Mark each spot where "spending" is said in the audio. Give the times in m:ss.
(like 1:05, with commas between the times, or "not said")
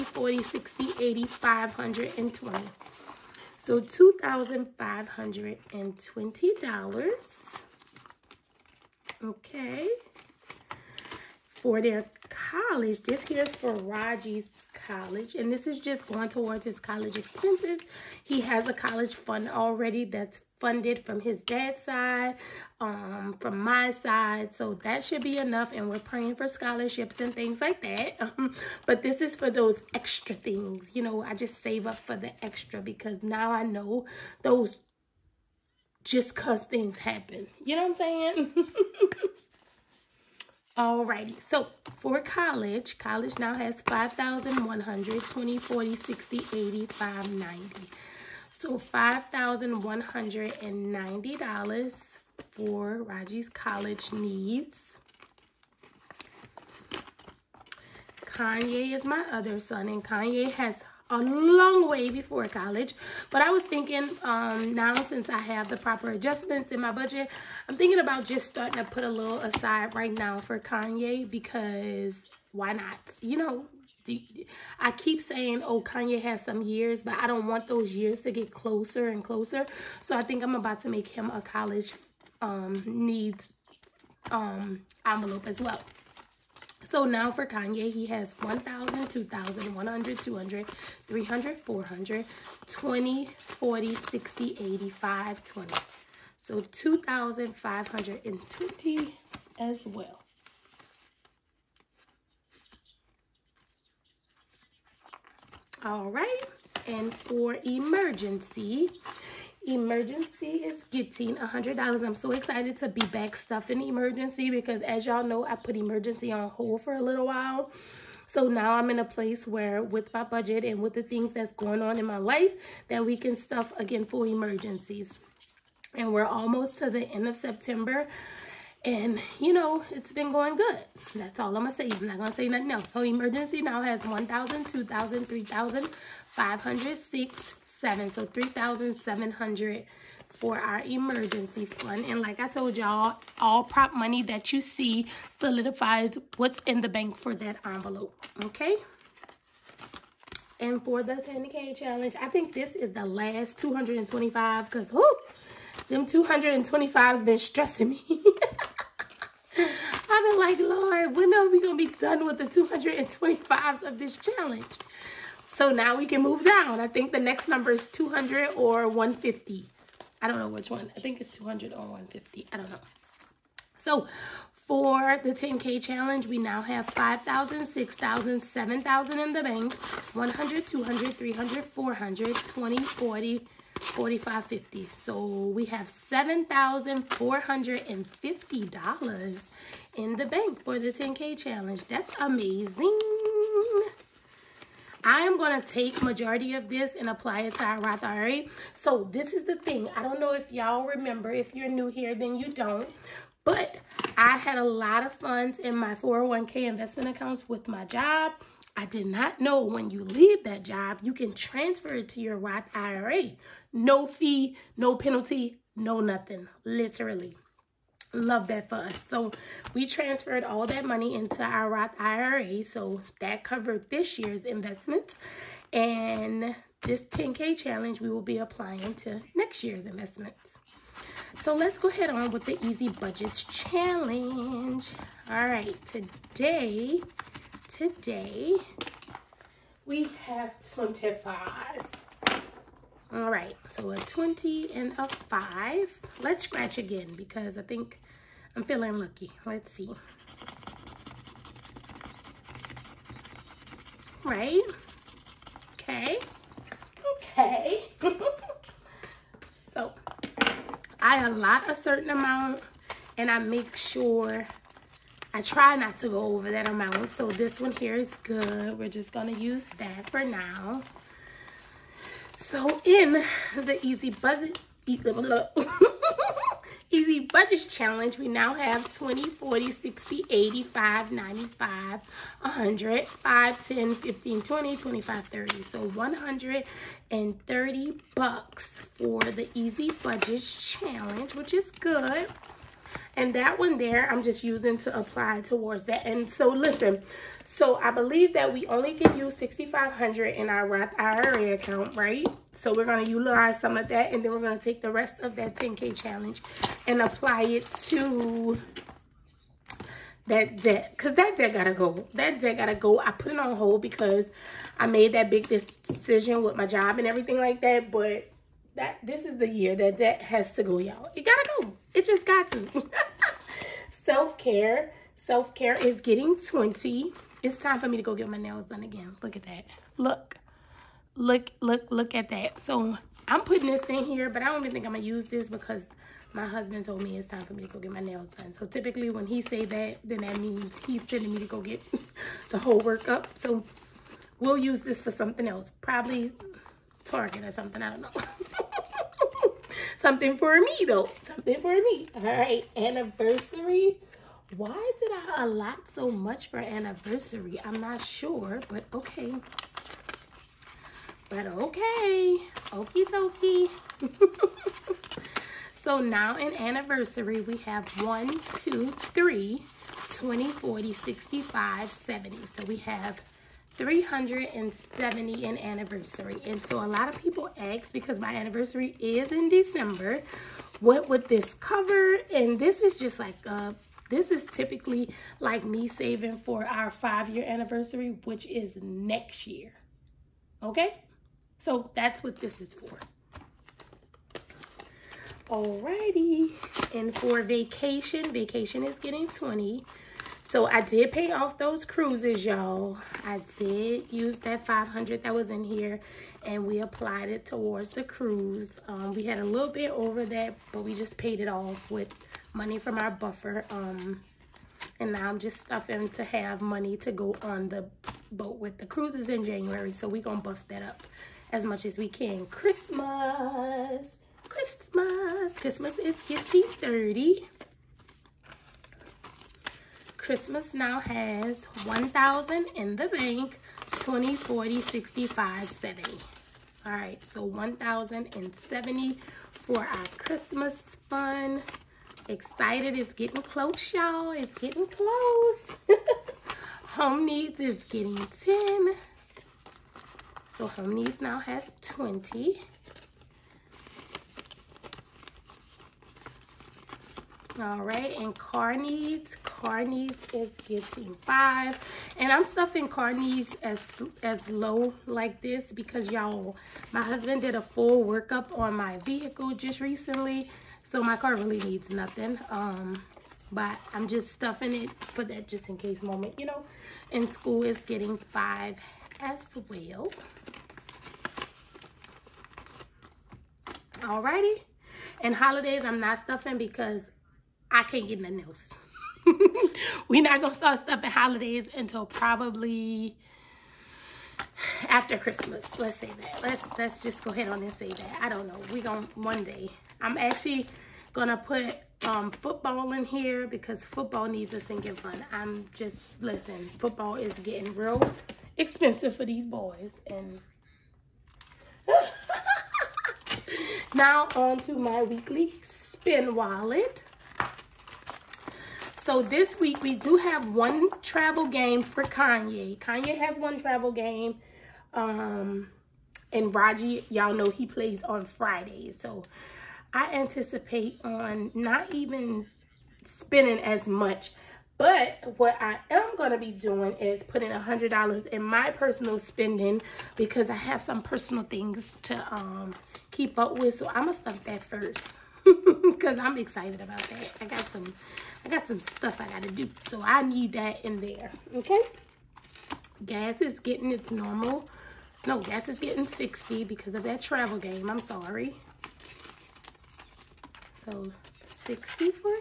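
8:53, 8:59.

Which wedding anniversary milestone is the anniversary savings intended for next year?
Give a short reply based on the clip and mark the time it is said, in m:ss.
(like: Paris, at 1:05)
five-year, at 6:26.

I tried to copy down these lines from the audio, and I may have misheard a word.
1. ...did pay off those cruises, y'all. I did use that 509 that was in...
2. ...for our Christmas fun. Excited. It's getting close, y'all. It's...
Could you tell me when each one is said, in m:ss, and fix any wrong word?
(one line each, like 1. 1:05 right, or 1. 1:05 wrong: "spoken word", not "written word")
1. 6:40 wrong: "500", not "509"
2. 7:19 right.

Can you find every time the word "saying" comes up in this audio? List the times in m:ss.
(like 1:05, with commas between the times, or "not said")
0:37, 1:15.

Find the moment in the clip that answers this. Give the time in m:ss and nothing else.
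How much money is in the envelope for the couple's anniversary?
6:13.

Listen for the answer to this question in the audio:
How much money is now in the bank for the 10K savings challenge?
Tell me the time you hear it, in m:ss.
3:05.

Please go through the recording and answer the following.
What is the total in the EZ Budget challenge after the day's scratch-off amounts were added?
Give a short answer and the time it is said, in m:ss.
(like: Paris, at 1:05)
130, at 4:45.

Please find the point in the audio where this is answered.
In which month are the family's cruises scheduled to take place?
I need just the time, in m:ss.
6:59.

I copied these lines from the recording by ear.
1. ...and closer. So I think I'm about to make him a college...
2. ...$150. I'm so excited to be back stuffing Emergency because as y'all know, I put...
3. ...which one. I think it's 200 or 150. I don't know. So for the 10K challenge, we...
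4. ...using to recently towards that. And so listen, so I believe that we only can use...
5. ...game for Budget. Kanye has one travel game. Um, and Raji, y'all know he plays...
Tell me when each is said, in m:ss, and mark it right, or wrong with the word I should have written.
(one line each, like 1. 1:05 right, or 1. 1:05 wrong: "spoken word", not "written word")
1. 1:19 right
2. 1:51 wrong: "100", not "150"
3. 2:50 right
4. 4:54 wrong: "apply", not "recently"
5. 8:41 wrong: "Kanye", not "Budget".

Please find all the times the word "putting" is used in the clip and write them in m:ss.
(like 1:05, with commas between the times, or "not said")
5:33, 8:57.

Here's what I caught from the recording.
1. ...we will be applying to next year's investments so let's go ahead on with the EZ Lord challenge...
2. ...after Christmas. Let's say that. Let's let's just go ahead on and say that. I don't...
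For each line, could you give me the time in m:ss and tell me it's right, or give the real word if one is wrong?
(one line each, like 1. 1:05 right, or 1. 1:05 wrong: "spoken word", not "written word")
1. 3:47 wrong: "Budgets", not "Lord"
2. 8:14 right.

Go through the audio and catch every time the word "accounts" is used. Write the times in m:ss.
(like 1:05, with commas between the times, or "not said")
3:27, 5:01.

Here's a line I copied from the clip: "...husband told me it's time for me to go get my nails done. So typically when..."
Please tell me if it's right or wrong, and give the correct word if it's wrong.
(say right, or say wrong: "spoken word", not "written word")
right.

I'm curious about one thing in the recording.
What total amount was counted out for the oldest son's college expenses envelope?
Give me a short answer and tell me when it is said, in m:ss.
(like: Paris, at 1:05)
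$2,520, at 0:03.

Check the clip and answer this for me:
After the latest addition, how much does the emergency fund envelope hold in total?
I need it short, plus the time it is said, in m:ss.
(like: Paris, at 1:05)
3700, at 2:18.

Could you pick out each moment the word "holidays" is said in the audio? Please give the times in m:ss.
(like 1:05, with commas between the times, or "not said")
8:05, 8:11.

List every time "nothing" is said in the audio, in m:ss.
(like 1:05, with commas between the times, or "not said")
2:12, 3:35, 7:51, 8:08.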